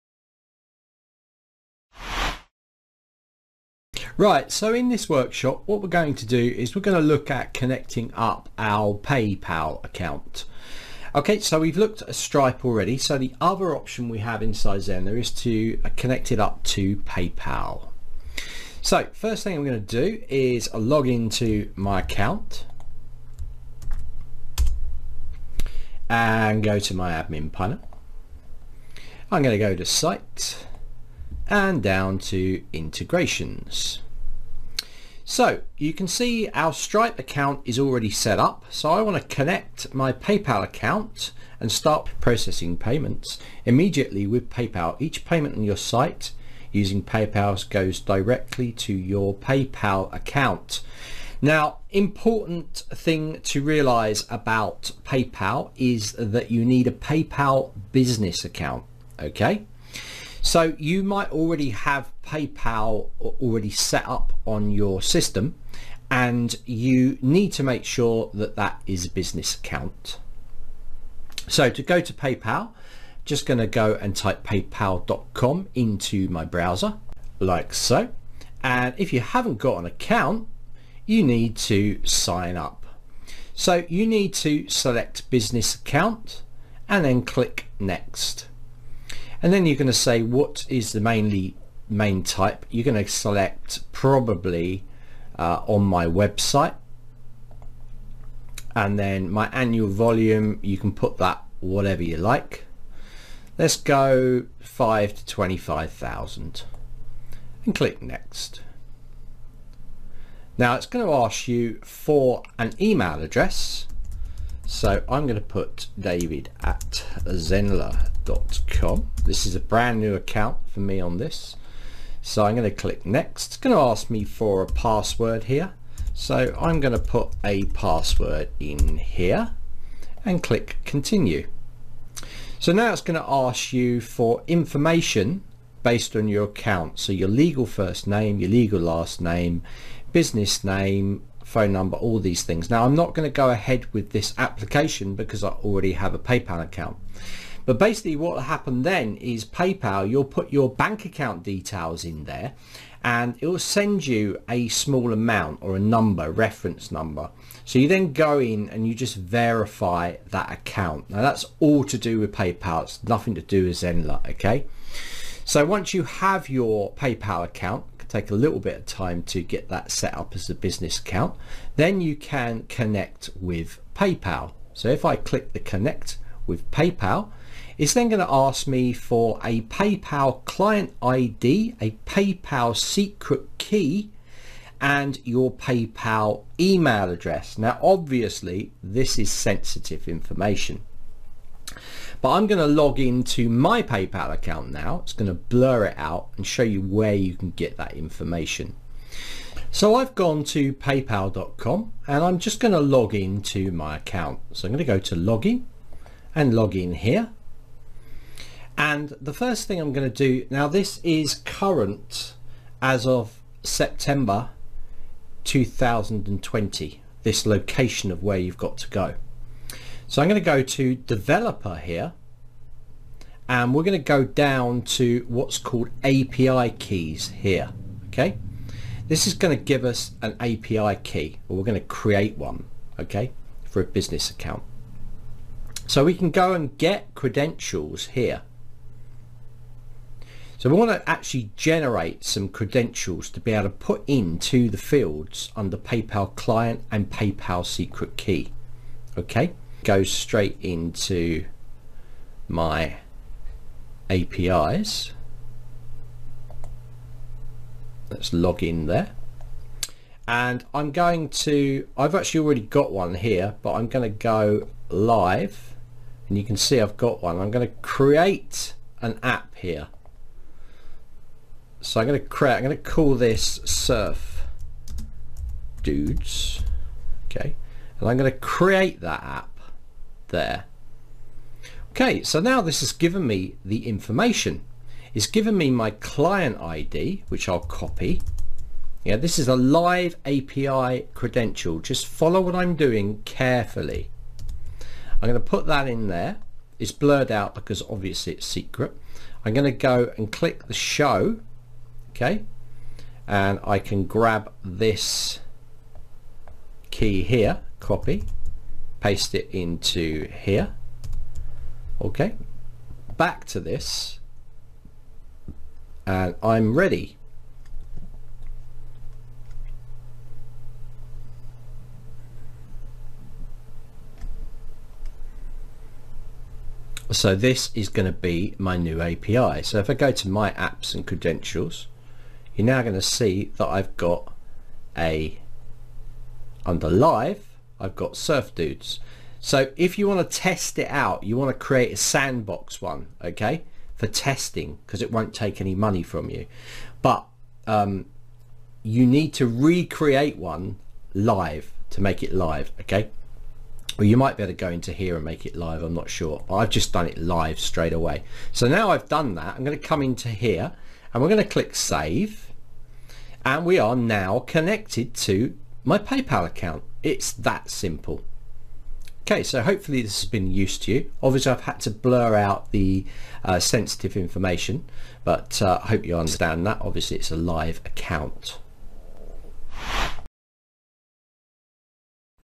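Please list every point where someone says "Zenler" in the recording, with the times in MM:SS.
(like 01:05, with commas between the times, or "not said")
00:14, 01:57, 02:43.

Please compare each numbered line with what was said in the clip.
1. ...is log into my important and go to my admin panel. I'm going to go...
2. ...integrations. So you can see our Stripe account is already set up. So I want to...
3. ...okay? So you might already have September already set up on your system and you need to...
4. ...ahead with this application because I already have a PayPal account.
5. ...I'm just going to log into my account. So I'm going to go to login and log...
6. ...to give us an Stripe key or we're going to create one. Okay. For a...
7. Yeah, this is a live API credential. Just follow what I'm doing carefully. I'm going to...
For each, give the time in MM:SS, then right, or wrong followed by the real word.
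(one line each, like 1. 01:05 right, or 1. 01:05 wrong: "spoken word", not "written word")
1. 00:20 wrong: "account", not "important"
2. 00:32 right
3. 00:59 wrong: "PayPal", not "September"
4. 02:23 right
5. 03:22 right
6. 03:49 wrong: "API", not "Stripe"
7. 04:49 right.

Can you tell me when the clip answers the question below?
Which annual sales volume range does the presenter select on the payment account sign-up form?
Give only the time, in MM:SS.
01:44.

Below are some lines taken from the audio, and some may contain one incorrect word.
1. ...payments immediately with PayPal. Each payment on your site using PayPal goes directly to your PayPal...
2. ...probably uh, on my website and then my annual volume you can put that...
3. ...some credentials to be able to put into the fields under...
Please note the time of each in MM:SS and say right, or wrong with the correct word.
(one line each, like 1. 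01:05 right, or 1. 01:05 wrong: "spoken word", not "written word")
1. 00:42 right
2. 01:33 right
3. 04:02 right.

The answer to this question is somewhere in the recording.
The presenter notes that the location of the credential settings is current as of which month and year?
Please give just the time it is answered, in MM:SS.
03:33.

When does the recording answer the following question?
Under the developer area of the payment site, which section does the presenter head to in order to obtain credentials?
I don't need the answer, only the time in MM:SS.
03:46.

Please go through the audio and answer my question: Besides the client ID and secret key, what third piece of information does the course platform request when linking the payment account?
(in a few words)
PayPal email address.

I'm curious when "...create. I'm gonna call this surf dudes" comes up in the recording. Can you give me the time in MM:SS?
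04:32.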